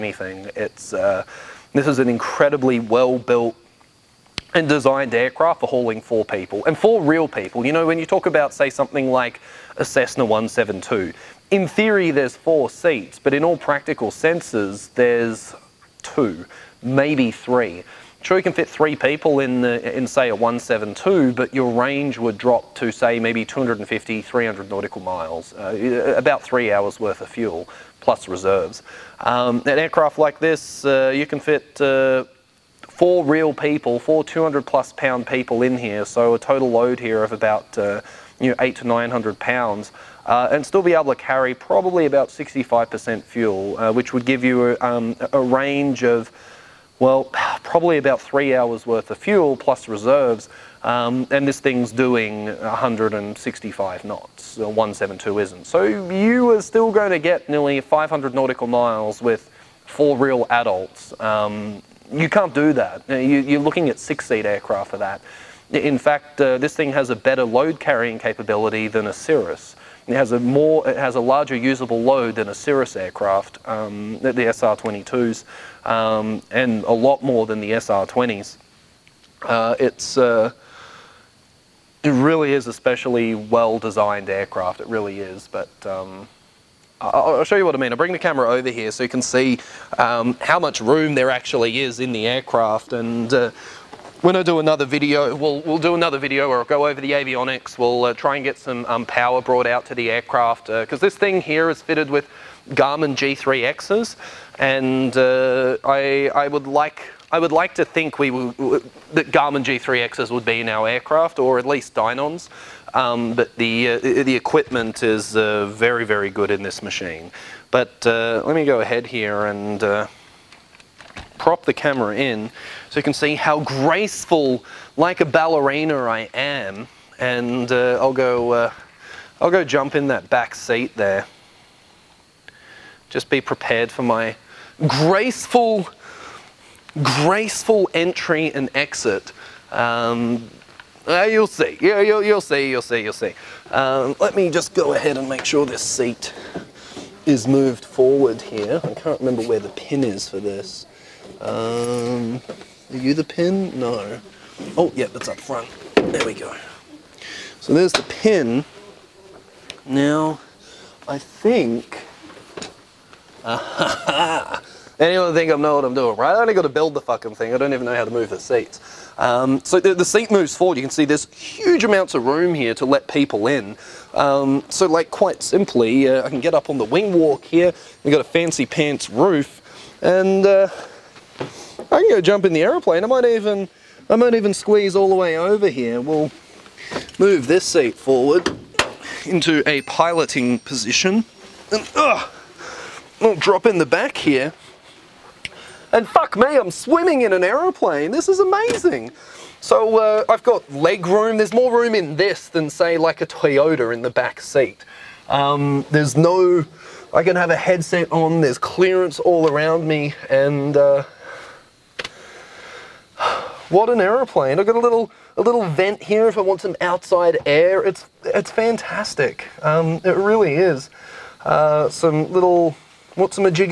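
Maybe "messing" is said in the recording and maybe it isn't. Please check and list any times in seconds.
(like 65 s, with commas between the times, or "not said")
not said.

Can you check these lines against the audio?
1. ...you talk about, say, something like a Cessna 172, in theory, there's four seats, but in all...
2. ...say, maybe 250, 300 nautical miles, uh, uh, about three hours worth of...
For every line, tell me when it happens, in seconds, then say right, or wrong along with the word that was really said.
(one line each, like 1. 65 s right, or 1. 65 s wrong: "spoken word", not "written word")
1. 7 s right
2. 22 s right.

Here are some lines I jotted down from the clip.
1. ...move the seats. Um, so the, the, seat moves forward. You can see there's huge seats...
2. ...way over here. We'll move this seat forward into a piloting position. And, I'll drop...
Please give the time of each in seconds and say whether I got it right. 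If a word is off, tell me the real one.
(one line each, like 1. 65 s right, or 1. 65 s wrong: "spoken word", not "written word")
1. 168 s wrong: "amounts", not "seats"
2. 185 s right.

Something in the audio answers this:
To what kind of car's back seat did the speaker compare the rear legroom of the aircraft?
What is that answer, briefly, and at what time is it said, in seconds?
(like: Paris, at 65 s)
Toyota, at 203 s.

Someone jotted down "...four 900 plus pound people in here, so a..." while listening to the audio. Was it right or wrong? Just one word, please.
wrong.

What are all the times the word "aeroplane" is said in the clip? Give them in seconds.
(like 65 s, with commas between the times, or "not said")
182 s, 197 s, 213 s.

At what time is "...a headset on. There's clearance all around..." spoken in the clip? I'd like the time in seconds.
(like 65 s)
207 s.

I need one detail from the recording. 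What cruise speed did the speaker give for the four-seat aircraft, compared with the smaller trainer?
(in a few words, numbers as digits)
165 knots.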